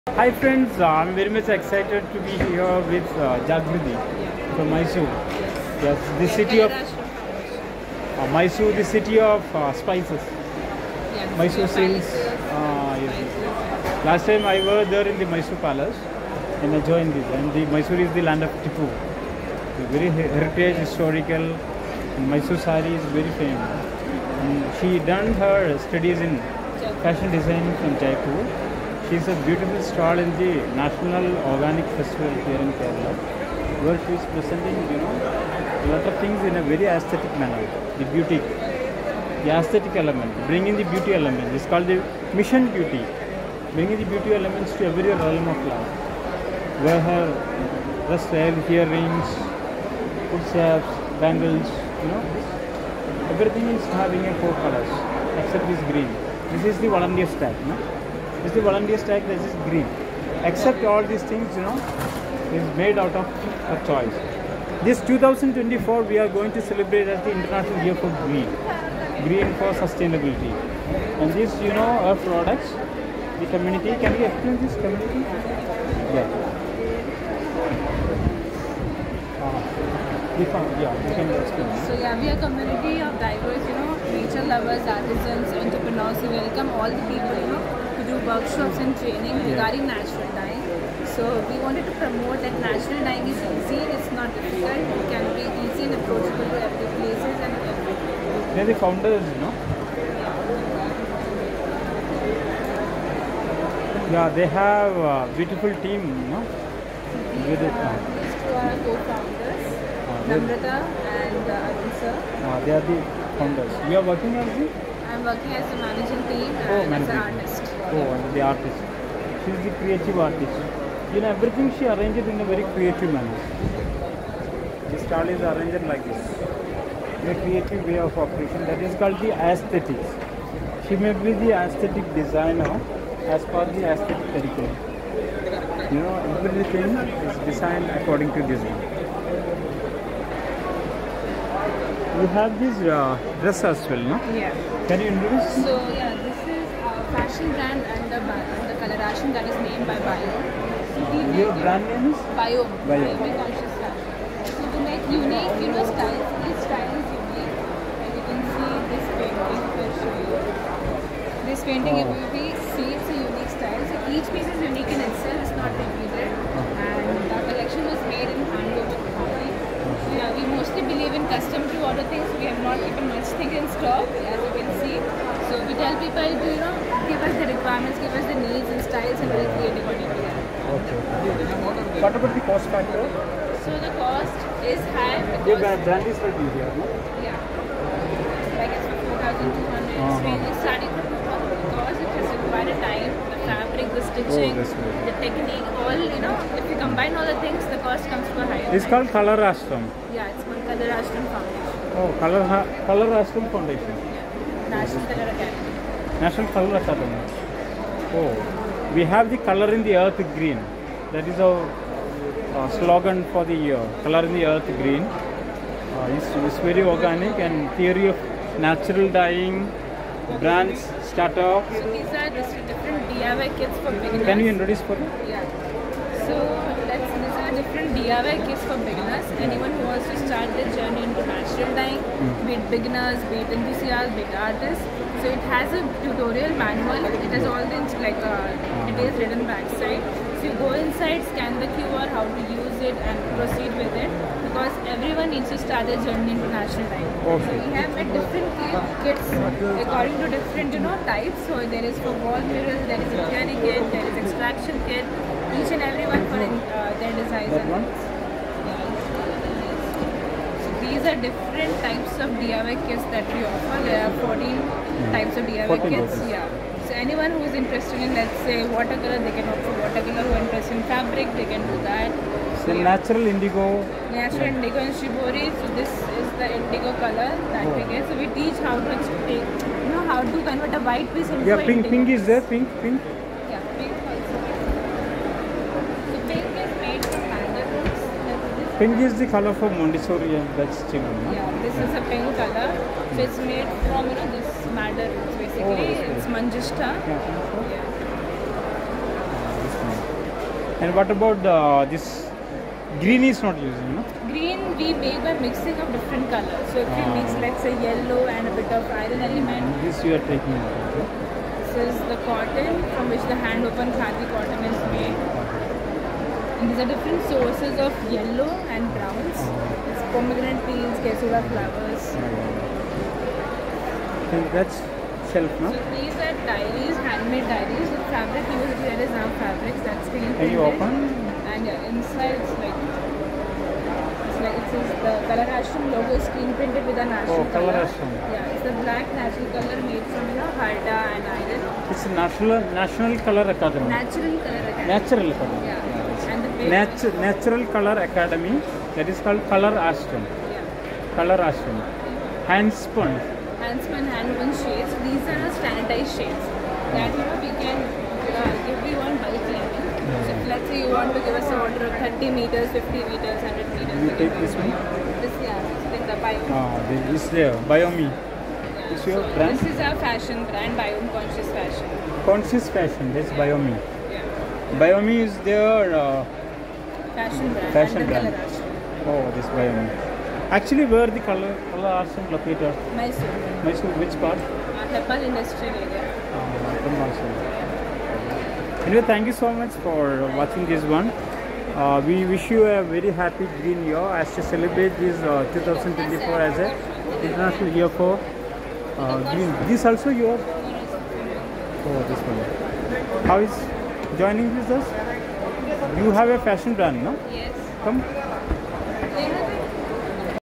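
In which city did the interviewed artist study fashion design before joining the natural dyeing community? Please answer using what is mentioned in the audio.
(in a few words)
Jaipur.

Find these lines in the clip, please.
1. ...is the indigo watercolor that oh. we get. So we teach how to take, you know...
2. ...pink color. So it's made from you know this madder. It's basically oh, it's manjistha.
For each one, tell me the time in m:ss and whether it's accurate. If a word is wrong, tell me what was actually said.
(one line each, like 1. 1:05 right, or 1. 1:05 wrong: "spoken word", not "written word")
1. 4:36 wrong: "color", not "watercolor"
2. 4:52 right.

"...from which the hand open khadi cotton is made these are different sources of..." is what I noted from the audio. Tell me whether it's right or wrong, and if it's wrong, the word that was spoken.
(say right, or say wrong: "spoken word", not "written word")
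right.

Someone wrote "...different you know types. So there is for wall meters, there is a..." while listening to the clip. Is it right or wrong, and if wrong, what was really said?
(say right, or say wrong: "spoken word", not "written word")
wrong: "mirrors", not "meters".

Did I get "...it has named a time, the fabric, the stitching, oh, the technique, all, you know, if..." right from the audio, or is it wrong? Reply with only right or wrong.
wrong.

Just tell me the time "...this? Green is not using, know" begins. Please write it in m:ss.
5:01.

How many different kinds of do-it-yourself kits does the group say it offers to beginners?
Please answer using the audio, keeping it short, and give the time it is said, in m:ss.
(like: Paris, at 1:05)
14, at 4:24.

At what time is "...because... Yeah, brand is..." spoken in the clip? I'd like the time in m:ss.
3:05.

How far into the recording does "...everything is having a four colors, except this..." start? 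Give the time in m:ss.
0:53.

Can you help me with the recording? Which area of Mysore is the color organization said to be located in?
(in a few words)
Industrial area.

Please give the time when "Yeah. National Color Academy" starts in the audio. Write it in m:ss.
3:23.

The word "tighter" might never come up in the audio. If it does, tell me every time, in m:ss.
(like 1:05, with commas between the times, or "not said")
not said.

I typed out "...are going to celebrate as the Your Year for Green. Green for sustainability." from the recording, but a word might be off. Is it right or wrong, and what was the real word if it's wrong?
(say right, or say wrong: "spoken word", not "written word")
wrong: "International", not "Your".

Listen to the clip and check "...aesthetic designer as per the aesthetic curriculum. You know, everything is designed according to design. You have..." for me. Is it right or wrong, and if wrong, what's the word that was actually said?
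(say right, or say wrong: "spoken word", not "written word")
right.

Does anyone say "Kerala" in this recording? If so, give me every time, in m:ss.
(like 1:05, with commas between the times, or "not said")
0:32.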